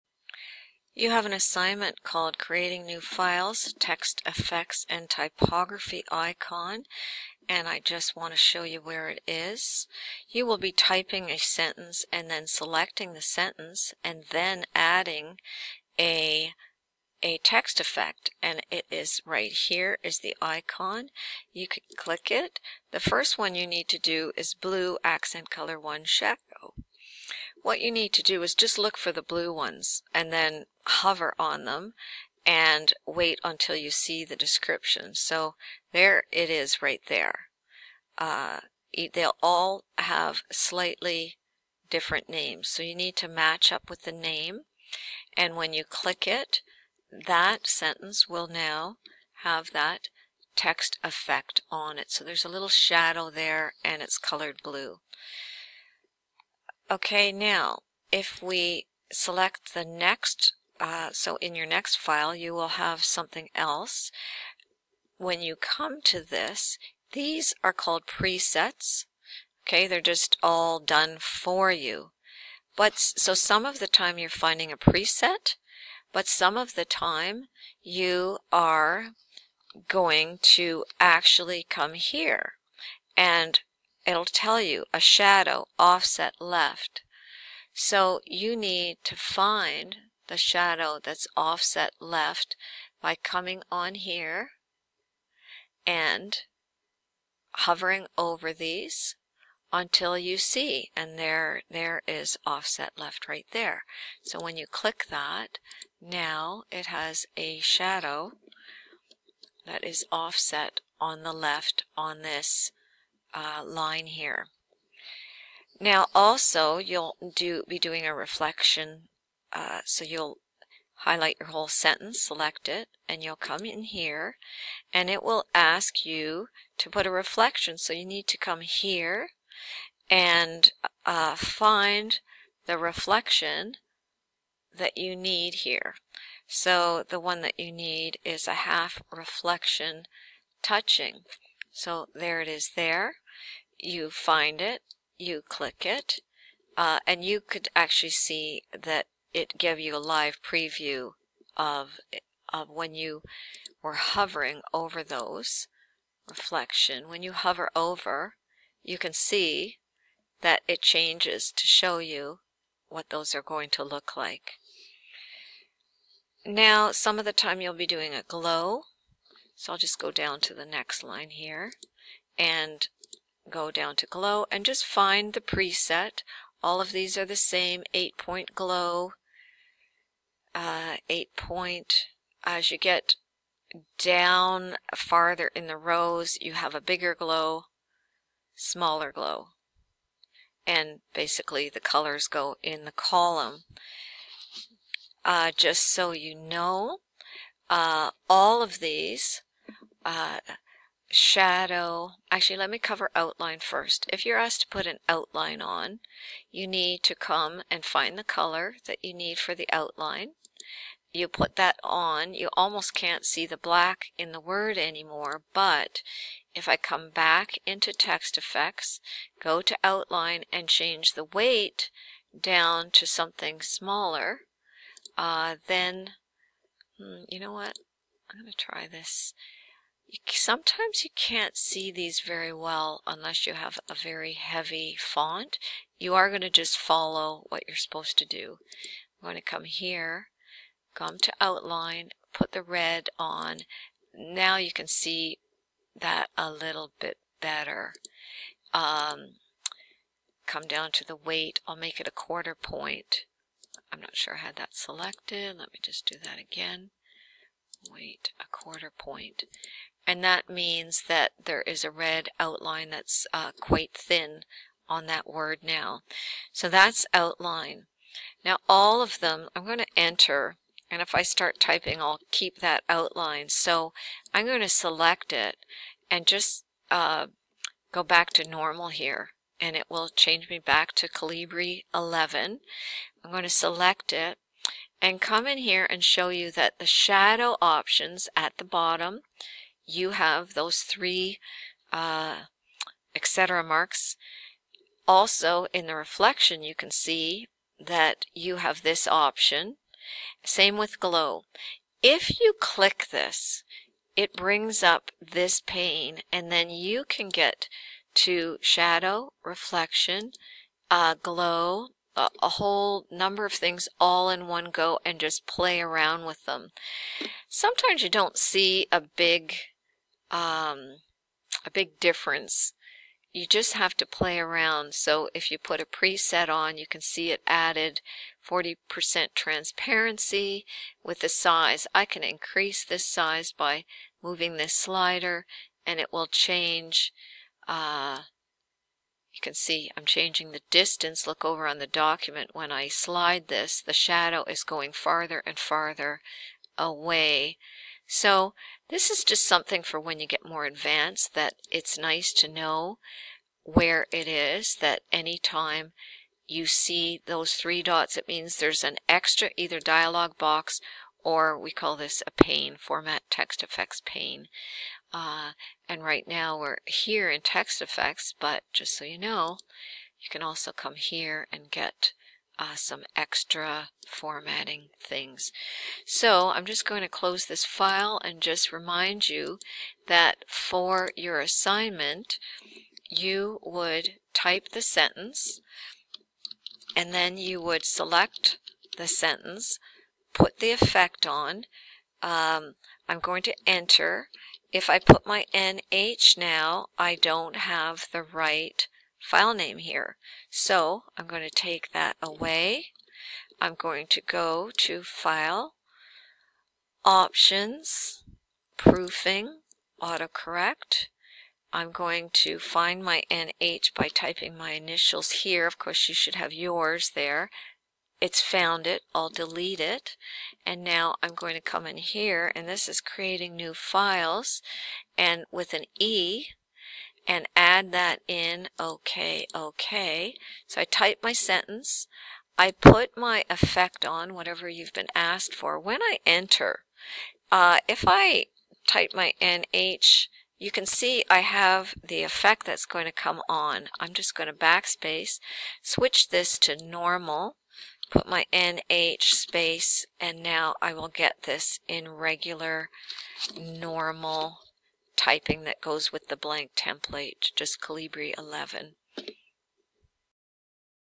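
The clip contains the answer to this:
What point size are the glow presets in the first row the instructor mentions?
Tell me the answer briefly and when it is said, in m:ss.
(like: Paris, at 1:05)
8-point, at 2:57.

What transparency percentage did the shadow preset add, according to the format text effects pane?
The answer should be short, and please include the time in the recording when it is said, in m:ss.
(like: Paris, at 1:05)
40%, at 5:28.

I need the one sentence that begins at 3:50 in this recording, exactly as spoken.
You, sometimes you can't see these very well unless you have a very heavy font.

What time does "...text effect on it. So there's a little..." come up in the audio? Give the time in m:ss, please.
0:50.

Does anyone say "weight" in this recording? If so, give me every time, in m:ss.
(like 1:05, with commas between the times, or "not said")
3:41, 4:11, 4:17.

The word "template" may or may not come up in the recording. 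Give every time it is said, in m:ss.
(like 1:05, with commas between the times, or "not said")
7:36.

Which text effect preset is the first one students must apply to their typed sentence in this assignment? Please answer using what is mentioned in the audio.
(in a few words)
Blue accent color one.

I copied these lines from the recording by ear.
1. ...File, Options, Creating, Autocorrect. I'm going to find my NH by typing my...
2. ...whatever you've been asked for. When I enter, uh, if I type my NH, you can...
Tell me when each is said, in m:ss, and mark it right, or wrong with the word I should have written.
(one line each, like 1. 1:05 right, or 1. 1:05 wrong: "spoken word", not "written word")
1. 6:45 wrong: "Proofing", not "Creating"
2. 7:14 right.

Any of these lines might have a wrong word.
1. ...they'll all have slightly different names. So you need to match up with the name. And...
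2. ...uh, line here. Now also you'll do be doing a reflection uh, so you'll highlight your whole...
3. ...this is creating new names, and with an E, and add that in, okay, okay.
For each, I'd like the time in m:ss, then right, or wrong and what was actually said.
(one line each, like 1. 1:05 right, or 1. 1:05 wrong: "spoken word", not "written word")
1. 0:39 right
2. 1:53 right
3. 7:02 wrong: "files", not "names".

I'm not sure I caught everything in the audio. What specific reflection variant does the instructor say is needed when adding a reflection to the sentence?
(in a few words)
Half reflection touching.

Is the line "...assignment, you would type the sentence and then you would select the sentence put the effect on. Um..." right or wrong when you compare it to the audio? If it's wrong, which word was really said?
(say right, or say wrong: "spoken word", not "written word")
right.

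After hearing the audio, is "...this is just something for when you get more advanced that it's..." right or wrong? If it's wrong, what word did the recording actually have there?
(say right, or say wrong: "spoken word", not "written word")
right.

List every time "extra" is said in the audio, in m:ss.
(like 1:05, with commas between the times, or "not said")
5:59, 6:13.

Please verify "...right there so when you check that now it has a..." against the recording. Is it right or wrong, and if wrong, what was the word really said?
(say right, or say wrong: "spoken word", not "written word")
wrong: "click", not "check".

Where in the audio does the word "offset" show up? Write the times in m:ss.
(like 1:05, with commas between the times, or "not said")
1:25, 1:31, 1:42, 1:50.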